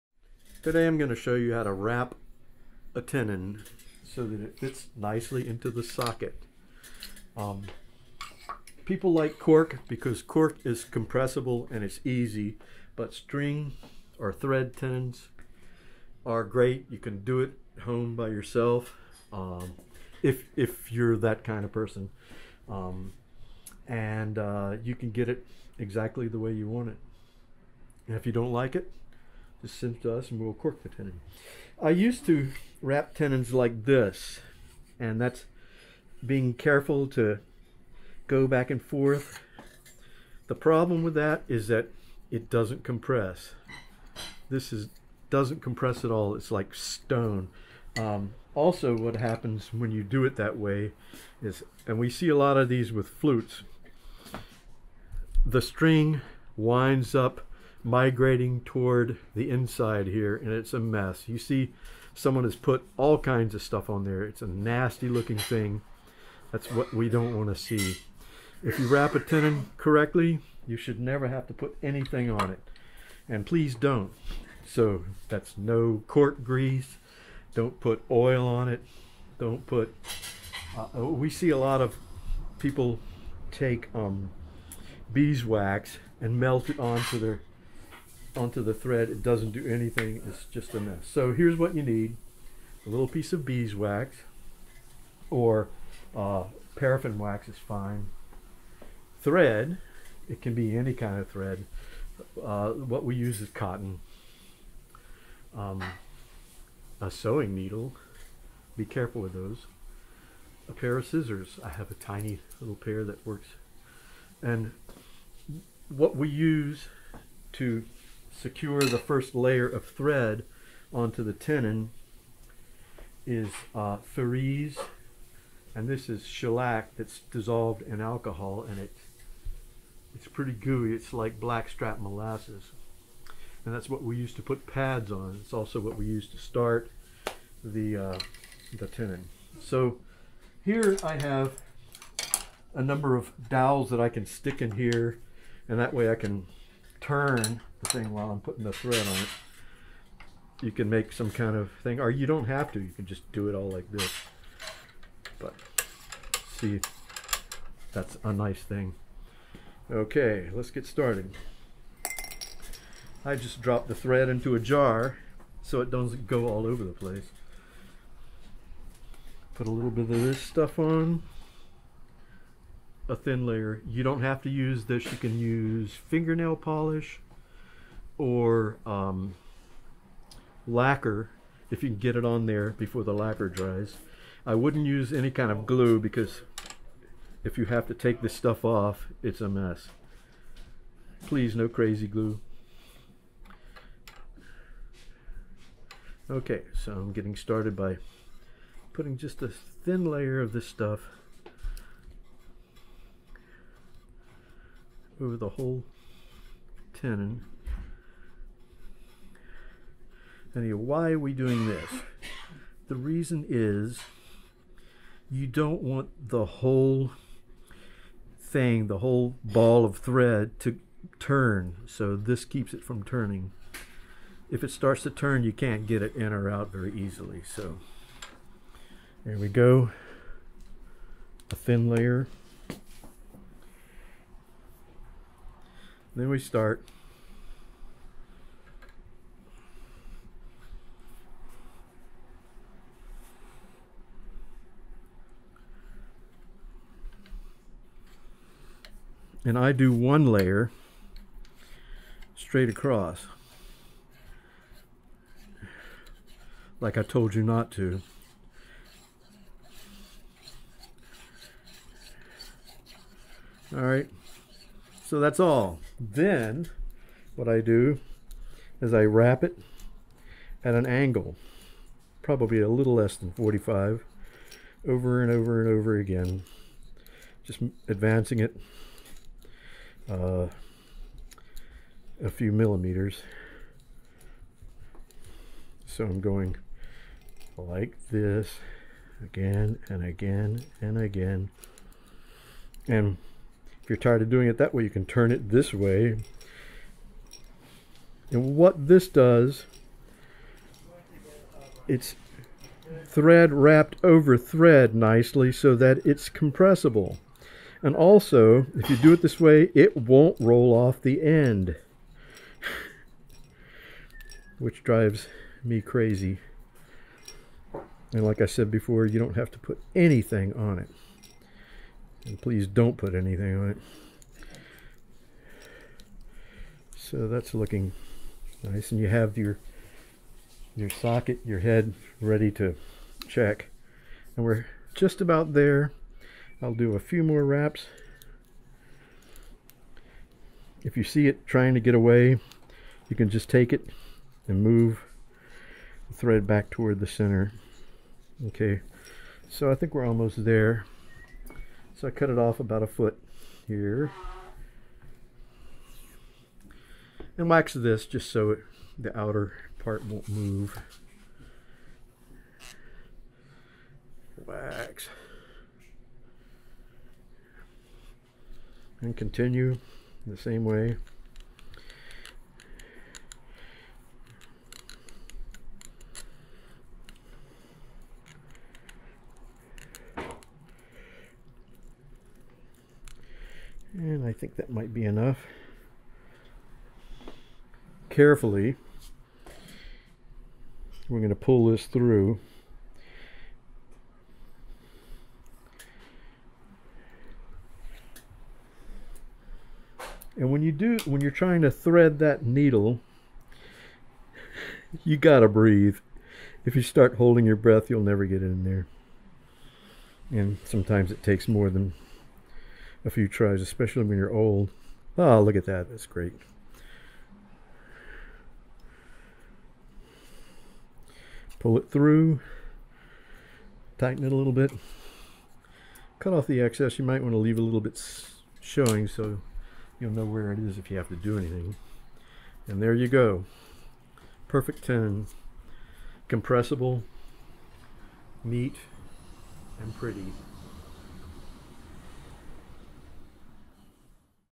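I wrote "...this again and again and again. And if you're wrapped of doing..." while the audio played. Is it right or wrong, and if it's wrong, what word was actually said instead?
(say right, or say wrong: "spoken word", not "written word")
wrong: "tired", not "wrapped".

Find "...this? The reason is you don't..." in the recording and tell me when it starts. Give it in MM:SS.
03:31.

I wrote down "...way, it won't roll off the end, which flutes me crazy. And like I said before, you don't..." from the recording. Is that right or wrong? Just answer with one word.
wrong.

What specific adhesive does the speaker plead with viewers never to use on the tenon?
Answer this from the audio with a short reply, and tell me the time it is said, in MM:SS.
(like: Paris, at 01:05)
Crazy glue, at 03:11.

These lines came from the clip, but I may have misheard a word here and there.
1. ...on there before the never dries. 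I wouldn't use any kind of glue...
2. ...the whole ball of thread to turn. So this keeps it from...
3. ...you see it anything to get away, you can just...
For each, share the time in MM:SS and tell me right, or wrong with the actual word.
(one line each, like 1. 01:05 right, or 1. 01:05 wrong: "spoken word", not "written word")
1. 03:02 wrong: "lacquer", not "never"
2. 03:38 right
3. 05:40 wrong: "trying", not "anything".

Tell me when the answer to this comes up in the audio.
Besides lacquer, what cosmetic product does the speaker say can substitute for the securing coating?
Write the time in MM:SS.
02:56.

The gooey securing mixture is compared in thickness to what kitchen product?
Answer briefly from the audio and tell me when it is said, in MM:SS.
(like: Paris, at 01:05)
Blackstrap molasses, at 02:11.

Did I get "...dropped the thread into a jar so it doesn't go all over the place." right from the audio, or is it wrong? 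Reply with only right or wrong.
right.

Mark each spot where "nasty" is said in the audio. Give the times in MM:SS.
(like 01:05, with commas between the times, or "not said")
01:04.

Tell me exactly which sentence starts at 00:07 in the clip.
Um, people like cork because cork is compressible and it's easy, but string or thread tenons are great.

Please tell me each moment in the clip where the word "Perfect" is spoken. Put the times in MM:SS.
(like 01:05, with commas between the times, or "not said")
07:14.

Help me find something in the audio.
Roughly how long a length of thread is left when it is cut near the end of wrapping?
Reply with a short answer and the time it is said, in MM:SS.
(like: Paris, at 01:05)
A foot, at 05:52.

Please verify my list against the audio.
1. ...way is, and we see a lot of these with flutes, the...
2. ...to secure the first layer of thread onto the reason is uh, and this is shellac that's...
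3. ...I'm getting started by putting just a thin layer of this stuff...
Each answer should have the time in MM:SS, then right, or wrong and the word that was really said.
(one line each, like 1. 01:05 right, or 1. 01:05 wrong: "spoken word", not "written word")
1. 00:50 right
2. 01:57 wrong: "tenon", not "reason"
3. 03:16 right.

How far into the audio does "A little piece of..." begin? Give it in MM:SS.
01:32.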